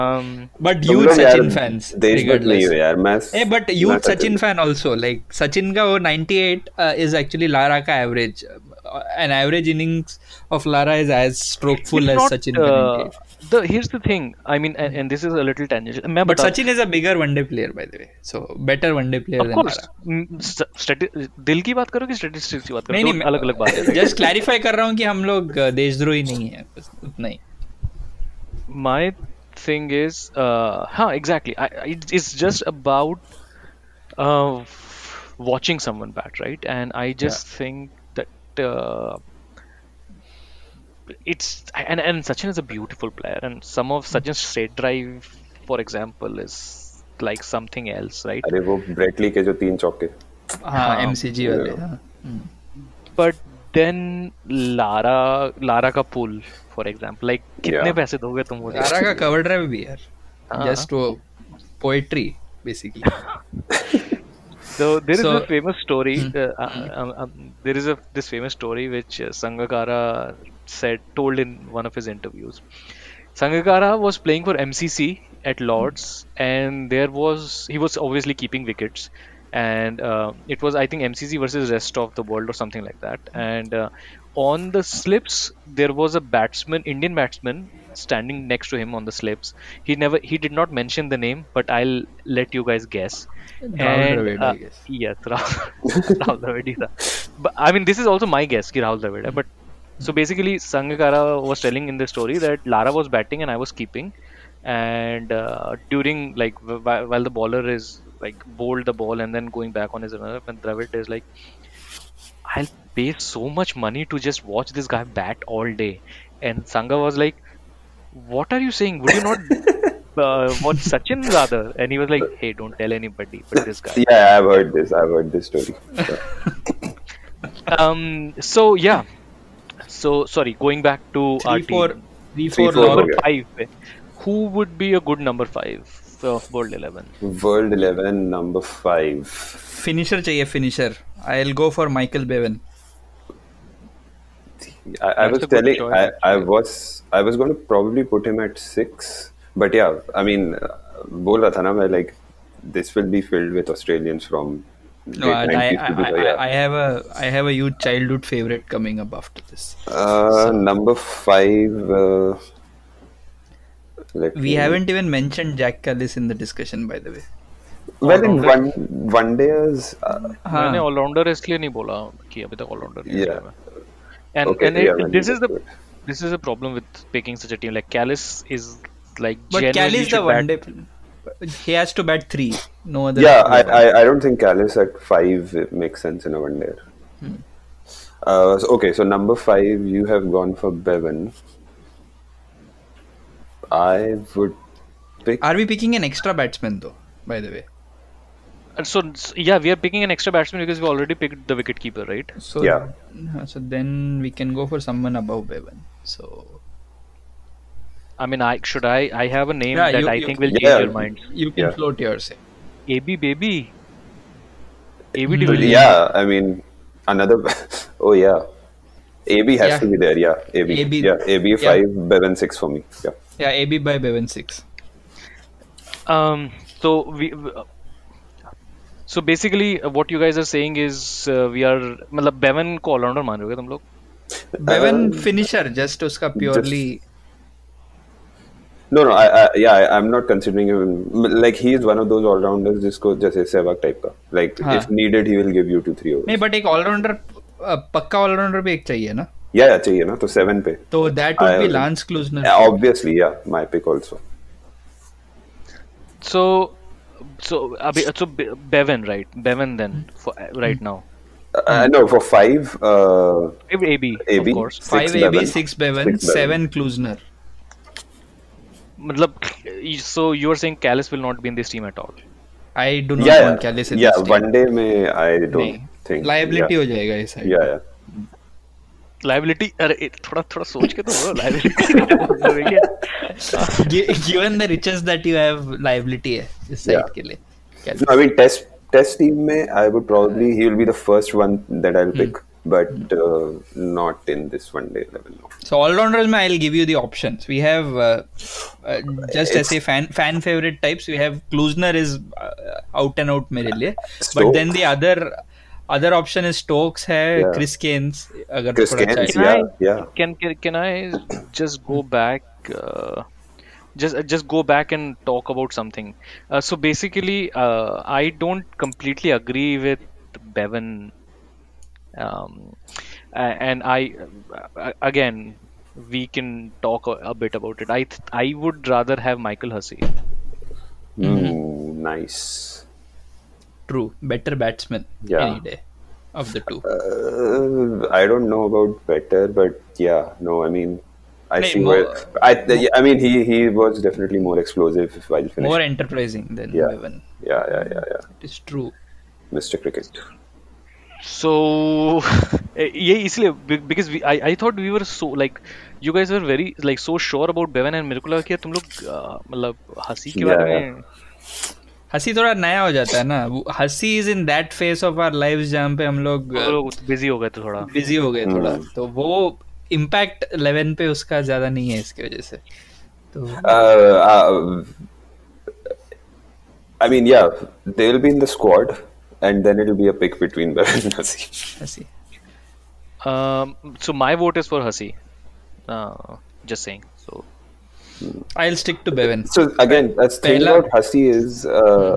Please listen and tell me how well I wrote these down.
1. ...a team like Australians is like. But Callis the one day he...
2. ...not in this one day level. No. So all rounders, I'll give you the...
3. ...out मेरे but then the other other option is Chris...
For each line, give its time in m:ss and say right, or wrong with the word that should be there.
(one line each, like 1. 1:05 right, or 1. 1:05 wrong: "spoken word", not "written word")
1. 2:57 wrong: "Callis", not "Australians"
2. 4:53 right
3. 5:03 wrong: "Stokes", not "Chris".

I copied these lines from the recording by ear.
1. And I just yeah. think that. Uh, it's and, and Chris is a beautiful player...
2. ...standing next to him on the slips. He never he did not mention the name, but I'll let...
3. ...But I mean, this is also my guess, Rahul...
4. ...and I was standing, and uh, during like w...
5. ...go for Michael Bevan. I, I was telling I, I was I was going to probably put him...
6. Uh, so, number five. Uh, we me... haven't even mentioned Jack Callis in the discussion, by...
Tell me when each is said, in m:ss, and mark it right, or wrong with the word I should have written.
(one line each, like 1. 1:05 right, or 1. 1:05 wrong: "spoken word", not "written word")
1. 0:36 wrong: "Sachin", not "Chris"
2. 1:27 right
3. 1:37 right
4. 1:43 wrong: "keeping", not "standing"
5. 2:21 right
6. 2:39 right.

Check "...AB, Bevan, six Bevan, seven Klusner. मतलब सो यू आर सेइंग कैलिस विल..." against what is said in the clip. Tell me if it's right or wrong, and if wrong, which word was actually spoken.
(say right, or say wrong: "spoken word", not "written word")
right.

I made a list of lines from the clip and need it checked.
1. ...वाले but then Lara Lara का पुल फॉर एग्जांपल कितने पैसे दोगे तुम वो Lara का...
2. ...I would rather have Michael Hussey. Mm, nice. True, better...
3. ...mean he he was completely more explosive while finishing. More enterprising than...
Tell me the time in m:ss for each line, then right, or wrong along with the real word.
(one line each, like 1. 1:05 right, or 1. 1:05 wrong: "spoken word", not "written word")
1. 0:51 right
2. 5:28 right
3. 5:43 wrong: "definitely", not "completely".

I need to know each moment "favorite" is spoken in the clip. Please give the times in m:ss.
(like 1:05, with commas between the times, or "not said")
2:38, 5:00.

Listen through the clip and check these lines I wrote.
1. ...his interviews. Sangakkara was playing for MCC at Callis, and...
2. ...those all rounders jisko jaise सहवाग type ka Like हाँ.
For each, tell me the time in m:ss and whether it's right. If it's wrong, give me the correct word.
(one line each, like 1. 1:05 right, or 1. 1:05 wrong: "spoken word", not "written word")
1. 1:11 wrong: "Lords", not "Callis"
2. 4:02 right.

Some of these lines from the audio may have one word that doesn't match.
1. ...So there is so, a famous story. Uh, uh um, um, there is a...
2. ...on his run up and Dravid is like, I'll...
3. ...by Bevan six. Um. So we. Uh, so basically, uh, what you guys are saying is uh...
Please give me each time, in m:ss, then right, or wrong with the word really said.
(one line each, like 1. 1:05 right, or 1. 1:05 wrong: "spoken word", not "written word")
1. 1:04 right
2. 1:49 right
3. 3:43 right.